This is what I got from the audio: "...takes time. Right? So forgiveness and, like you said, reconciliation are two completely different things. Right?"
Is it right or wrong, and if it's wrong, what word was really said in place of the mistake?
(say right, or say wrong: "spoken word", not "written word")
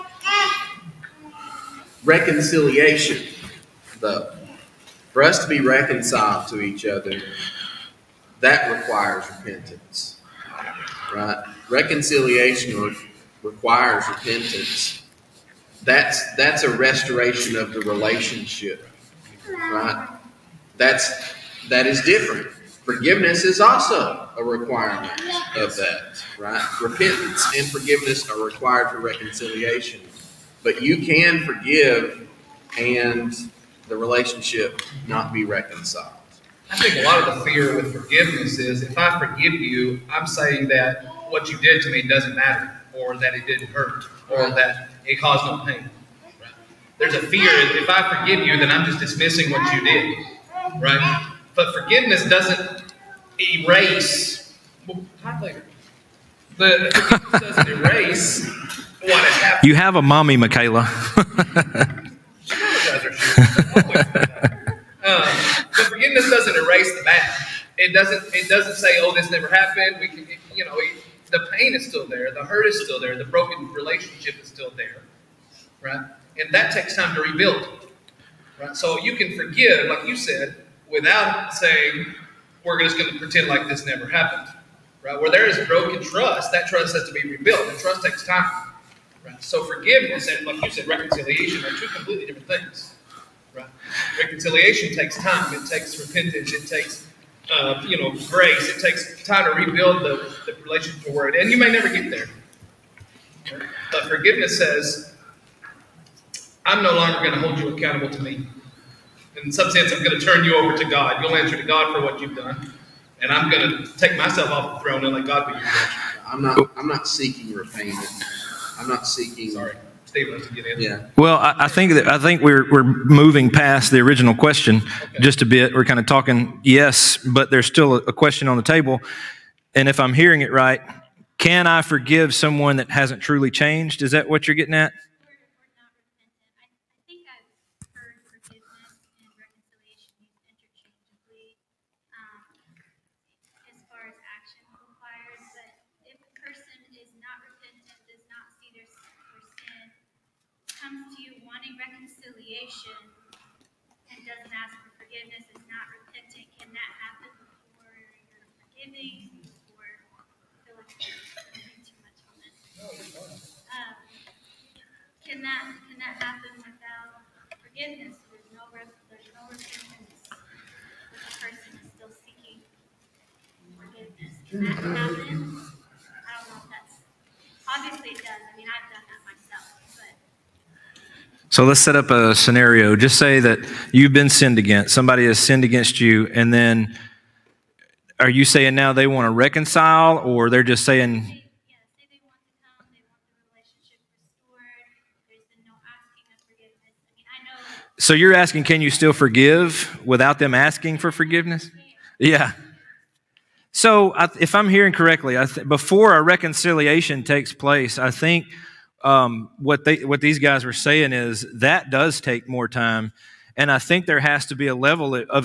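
right.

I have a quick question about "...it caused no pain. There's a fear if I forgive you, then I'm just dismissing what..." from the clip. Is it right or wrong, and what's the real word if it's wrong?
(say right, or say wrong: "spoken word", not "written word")
right.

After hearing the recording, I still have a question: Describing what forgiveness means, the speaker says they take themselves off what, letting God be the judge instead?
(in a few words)
the throne.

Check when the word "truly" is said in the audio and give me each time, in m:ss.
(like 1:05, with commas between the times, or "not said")
2:13.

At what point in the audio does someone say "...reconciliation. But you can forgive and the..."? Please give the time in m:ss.
0:28.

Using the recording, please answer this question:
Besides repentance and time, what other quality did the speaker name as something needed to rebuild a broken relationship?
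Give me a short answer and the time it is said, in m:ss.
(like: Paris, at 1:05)
grace, at 1:38.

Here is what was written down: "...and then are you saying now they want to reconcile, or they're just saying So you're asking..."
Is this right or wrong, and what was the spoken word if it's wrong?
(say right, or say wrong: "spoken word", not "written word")
right.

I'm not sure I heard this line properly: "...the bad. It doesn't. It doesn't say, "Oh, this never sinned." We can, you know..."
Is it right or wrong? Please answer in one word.
wrong.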